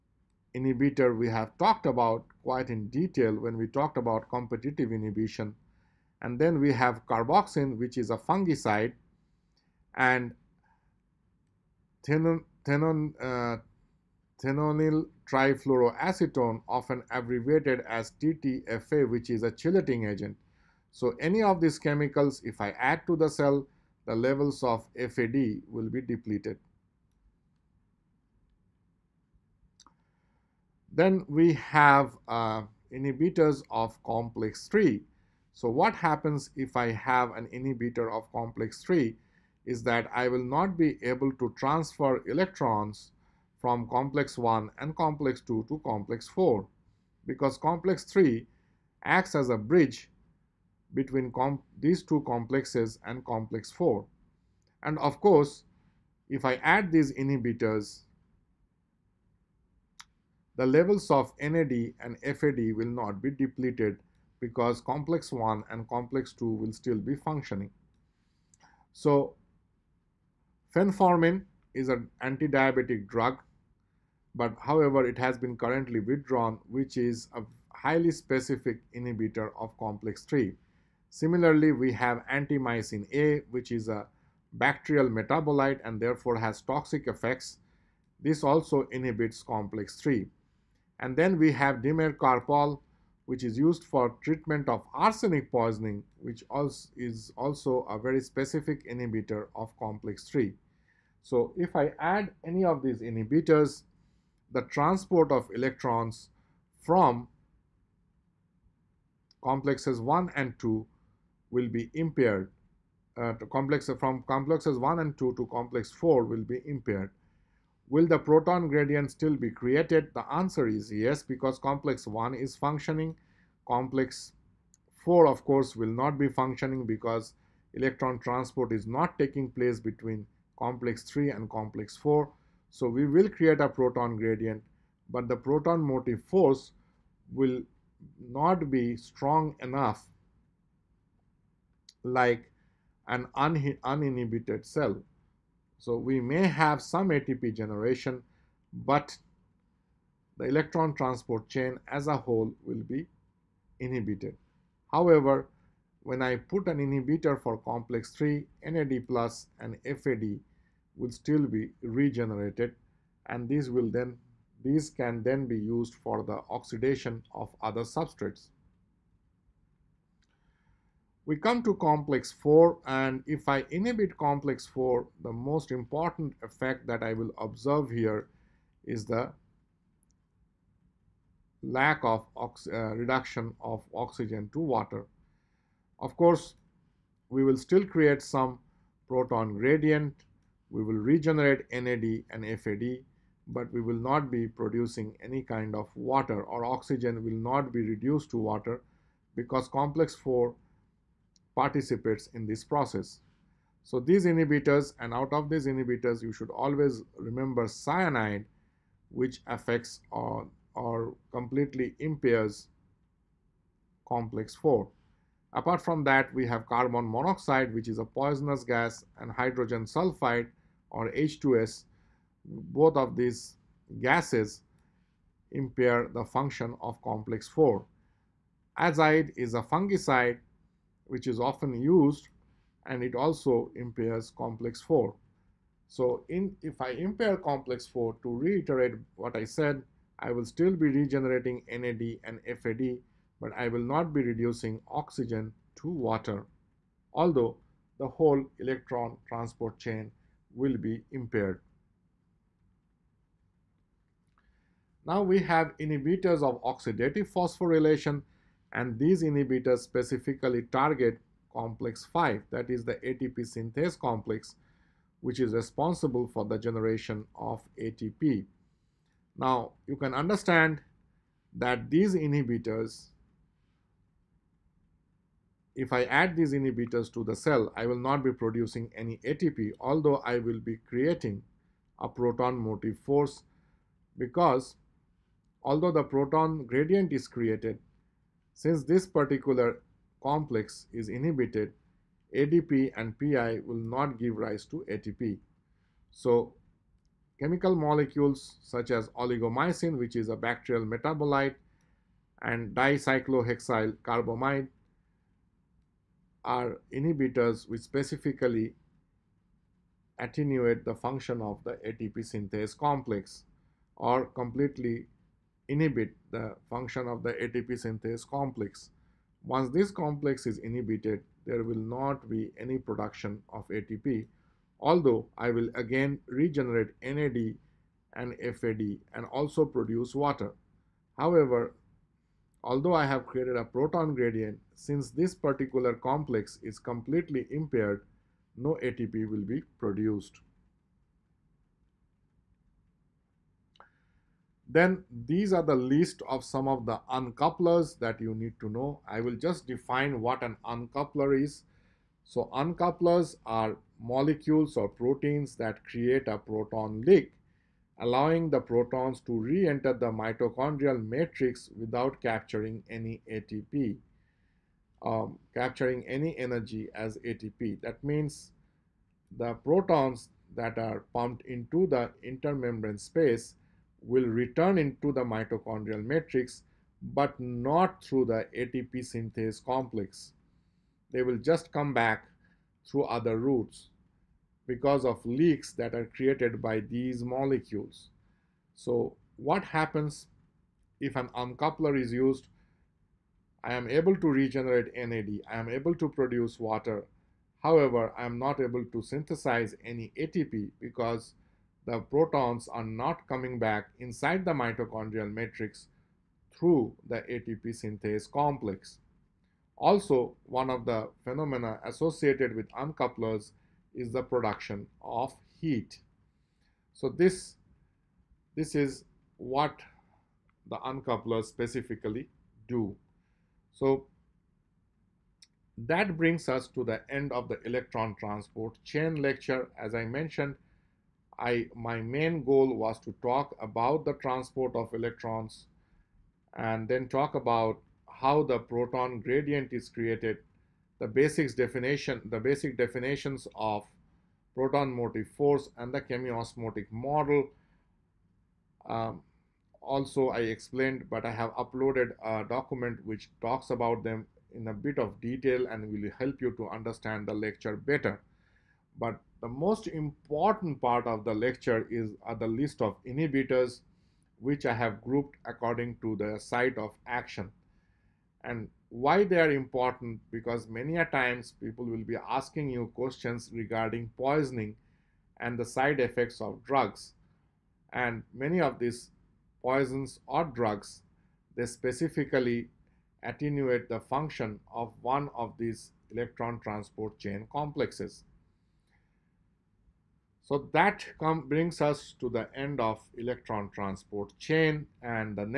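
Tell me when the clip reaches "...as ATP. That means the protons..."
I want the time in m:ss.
6:06.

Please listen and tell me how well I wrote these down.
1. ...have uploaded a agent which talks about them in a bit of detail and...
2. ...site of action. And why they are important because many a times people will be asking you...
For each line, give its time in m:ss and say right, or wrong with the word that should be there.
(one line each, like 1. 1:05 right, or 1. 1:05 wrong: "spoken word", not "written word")
1. 7:31 wrong: "document", not "agent"
2. 7:46 right.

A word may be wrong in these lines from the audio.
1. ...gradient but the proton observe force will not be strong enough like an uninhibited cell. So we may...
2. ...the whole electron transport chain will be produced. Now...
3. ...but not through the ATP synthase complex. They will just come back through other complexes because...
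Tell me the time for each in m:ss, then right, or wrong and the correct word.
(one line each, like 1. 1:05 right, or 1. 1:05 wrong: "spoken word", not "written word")
1. 2:14 wrong: "motive", not "observe"
2. 4:07 wrong: "impaired", not "produced"
3. 6:17 wrong: "routes", not "complexes".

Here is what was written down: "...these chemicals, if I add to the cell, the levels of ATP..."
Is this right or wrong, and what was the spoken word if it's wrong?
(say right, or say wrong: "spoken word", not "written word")
wrong: "FAD", not "ATP".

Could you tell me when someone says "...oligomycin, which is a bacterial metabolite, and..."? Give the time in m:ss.
4:59.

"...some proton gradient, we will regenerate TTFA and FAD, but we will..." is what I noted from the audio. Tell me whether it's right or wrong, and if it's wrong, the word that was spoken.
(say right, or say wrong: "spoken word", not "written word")
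wrong: "NAD", not "TTFA".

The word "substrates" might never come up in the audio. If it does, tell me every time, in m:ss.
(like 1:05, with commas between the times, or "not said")
2:47.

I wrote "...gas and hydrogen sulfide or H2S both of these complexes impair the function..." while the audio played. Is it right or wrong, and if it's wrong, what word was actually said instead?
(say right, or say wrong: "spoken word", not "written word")
wrong: "gases", not "complexes".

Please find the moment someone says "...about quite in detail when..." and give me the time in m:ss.
0:01.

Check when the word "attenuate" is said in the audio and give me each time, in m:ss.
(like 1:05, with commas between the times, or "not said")
5:10, 8:03.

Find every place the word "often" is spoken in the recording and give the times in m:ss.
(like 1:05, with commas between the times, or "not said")
0:16, 3:51.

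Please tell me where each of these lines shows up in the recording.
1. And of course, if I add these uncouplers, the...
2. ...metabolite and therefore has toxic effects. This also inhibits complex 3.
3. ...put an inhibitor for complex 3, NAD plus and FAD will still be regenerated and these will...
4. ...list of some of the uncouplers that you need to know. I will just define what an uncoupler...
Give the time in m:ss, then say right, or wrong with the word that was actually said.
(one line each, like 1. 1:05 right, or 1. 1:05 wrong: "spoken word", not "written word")
1. 0:54 wrong: "inhibitors", not "uncouplers"
2. 1:25 right
3. 2:36 right
4. 5:45 right.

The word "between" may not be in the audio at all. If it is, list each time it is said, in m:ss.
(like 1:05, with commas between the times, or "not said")
0:50, 2:09.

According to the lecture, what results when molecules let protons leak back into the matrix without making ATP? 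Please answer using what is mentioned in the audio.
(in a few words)
Production of heat.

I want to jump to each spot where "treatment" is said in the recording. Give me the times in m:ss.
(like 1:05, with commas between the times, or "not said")
1:34.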